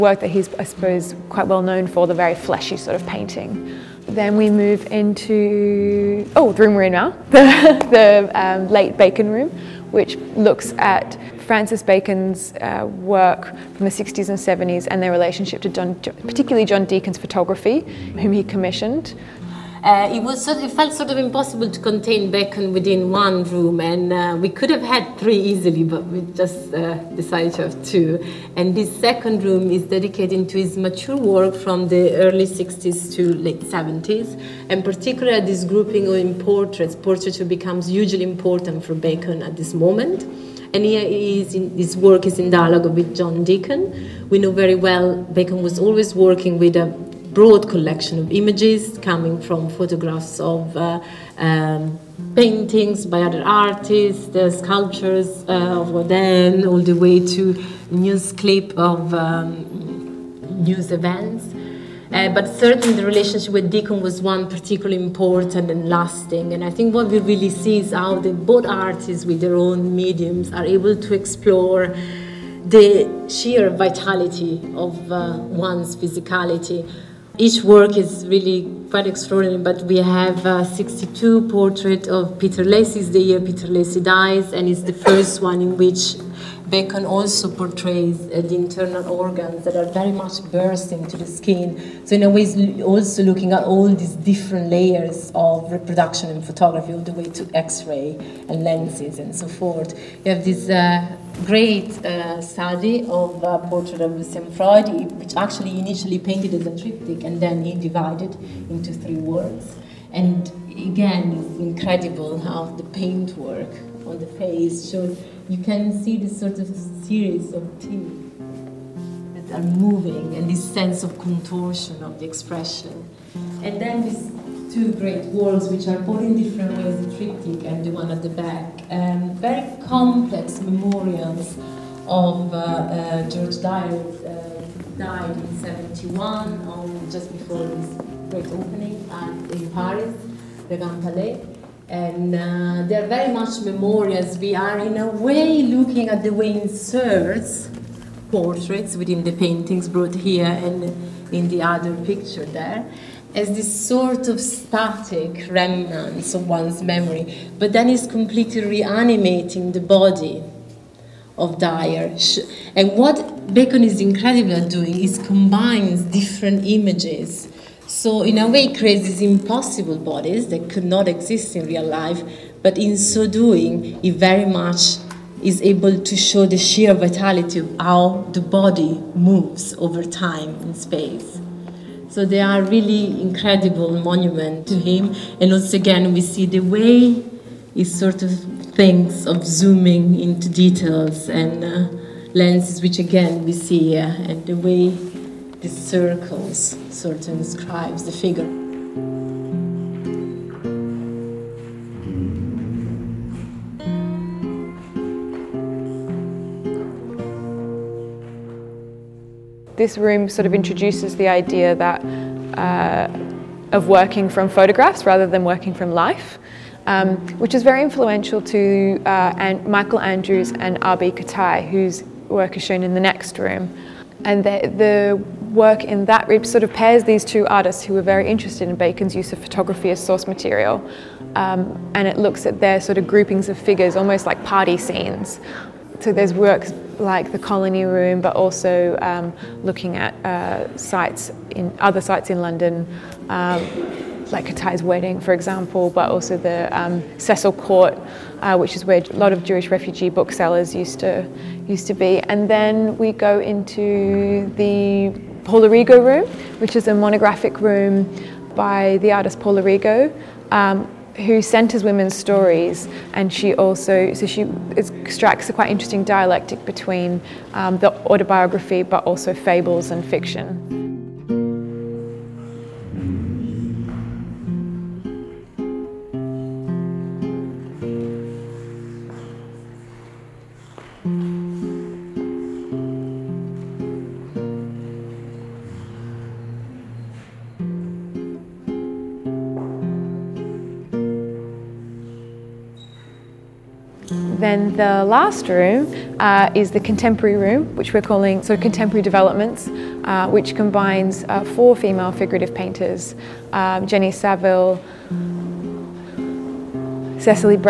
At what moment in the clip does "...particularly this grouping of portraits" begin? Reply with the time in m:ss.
0:34.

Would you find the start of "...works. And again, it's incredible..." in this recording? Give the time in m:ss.
1:49.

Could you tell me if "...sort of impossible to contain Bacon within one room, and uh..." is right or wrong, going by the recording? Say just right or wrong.
right.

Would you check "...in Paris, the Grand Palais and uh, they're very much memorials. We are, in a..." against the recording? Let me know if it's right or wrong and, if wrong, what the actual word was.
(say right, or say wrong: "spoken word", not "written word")
right.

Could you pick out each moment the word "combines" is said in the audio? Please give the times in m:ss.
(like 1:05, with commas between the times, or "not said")
2:45, 5:00.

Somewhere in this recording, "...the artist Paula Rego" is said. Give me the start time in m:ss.
4:18.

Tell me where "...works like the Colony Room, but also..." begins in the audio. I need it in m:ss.
3:56.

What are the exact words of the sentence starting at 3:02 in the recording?
So they are really incredible monument to him.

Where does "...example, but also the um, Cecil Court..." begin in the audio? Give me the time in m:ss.
4:05.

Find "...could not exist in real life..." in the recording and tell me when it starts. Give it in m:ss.
2:50.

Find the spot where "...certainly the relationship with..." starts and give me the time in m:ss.
1:02.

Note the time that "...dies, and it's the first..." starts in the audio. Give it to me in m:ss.
1:24.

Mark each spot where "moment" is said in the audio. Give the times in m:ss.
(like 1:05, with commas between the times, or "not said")
0:39.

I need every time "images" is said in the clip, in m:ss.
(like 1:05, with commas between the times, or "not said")
0:48, 2:46.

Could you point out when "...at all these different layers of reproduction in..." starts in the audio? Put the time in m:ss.
1:33.